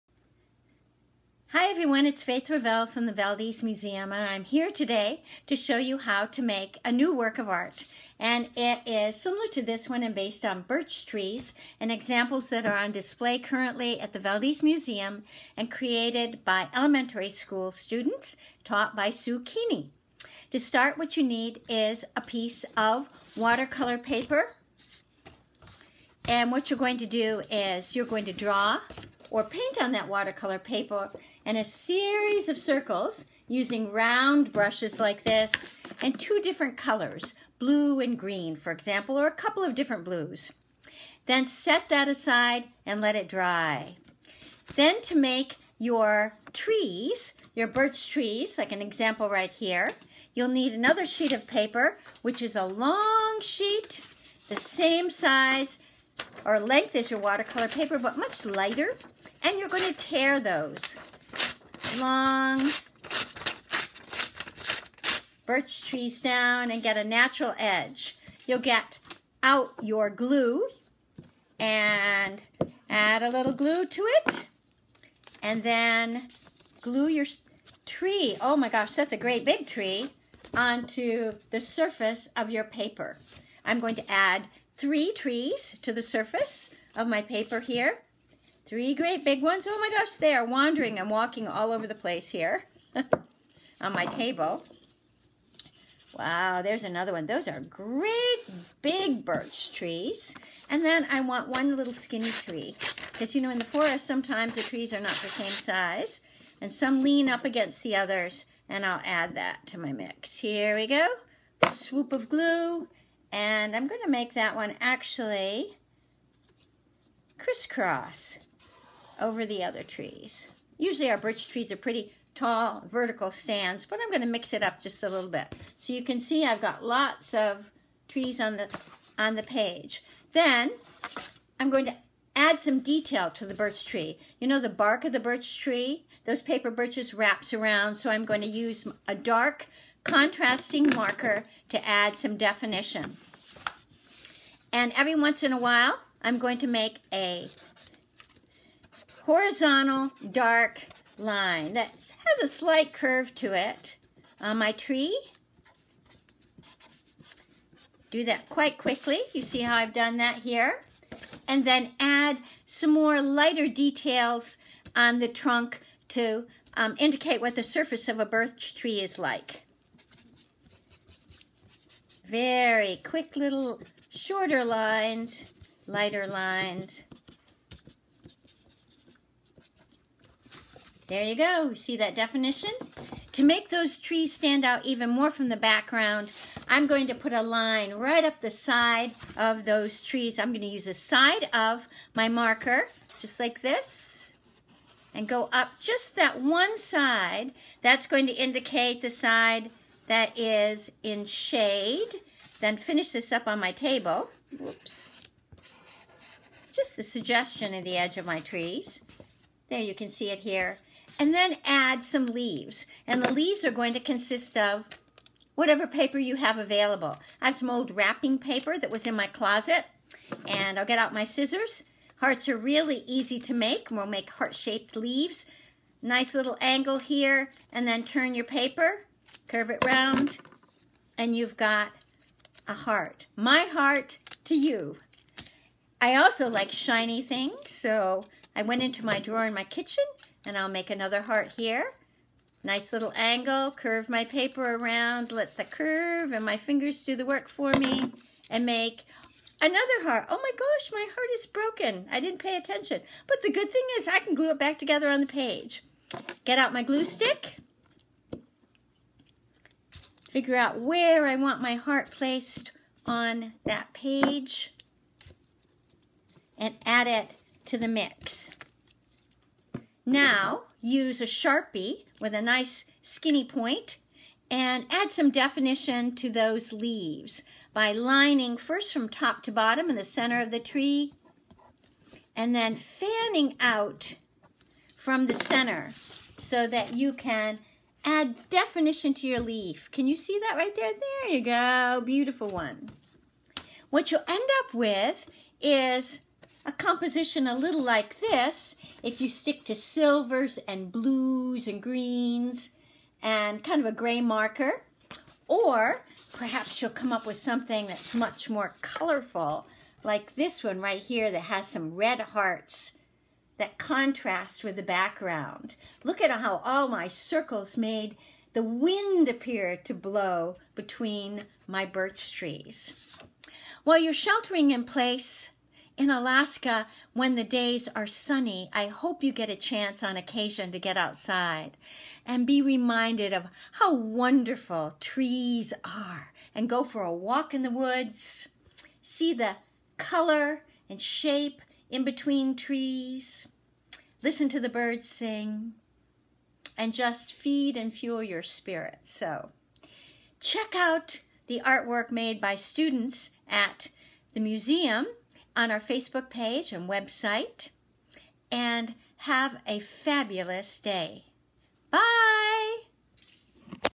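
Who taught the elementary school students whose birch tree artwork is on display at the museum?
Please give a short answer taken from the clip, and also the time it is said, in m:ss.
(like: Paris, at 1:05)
Sue Keeney, at 0:19.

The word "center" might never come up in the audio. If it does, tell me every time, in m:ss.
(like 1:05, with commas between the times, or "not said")
4:40, 4:45.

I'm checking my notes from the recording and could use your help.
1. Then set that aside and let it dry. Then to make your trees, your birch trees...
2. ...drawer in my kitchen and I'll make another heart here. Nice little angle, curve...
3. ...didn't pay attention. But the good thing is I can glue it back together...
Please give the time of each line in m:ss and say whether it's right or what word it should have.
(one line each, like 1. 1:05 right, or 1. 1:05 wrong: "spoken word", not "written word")
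1. 0:41 right
2. 3:59 right
3. 4:12 right.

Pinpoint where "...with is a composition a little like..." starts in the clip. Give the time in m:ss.
4:54.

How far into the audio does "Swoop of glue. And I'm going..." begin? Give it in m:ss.
1:51.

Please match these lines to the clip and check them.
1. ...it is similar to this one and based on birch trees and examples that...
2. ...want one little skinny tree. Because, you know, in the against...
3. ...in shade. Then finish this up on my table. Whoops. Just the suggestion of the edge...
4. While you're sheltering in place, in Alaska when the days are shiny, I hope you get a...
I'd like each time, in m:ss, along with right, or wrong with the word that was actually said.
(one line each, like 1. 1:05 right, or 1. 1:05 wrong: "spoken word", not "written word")
1. 0:08 right
2. 1:41 wrong: "forest", not "against"
3. 3:21 right
4. 5:23 wrong: "sunny", not "shiny".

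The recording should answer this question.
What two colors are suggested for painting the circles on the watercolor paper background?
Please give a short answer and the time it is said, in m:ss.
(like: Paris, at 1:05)
blue and green, at 0:37.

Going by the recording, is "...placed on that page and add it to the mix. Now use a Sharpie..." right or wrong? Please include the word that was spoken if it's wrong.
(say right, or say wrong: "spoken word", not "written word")
right.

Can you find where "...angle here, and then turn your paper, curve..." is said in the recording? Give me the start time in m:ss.
3:46.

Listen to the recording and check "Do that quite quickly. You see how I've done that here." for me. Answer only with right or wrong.
right.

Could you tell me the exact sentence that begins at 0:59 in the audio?
And you're going to tear those long birch trees down and get a natural edge.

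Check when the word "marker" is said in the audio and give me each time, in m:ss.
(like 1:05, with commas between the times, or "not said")
2:20, 3:12, 5:04.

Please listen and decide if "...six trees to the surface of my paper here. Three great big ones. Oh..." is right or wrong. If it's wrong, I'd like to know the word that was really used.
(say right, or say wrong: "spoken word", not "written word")
wrong: "three", not "six".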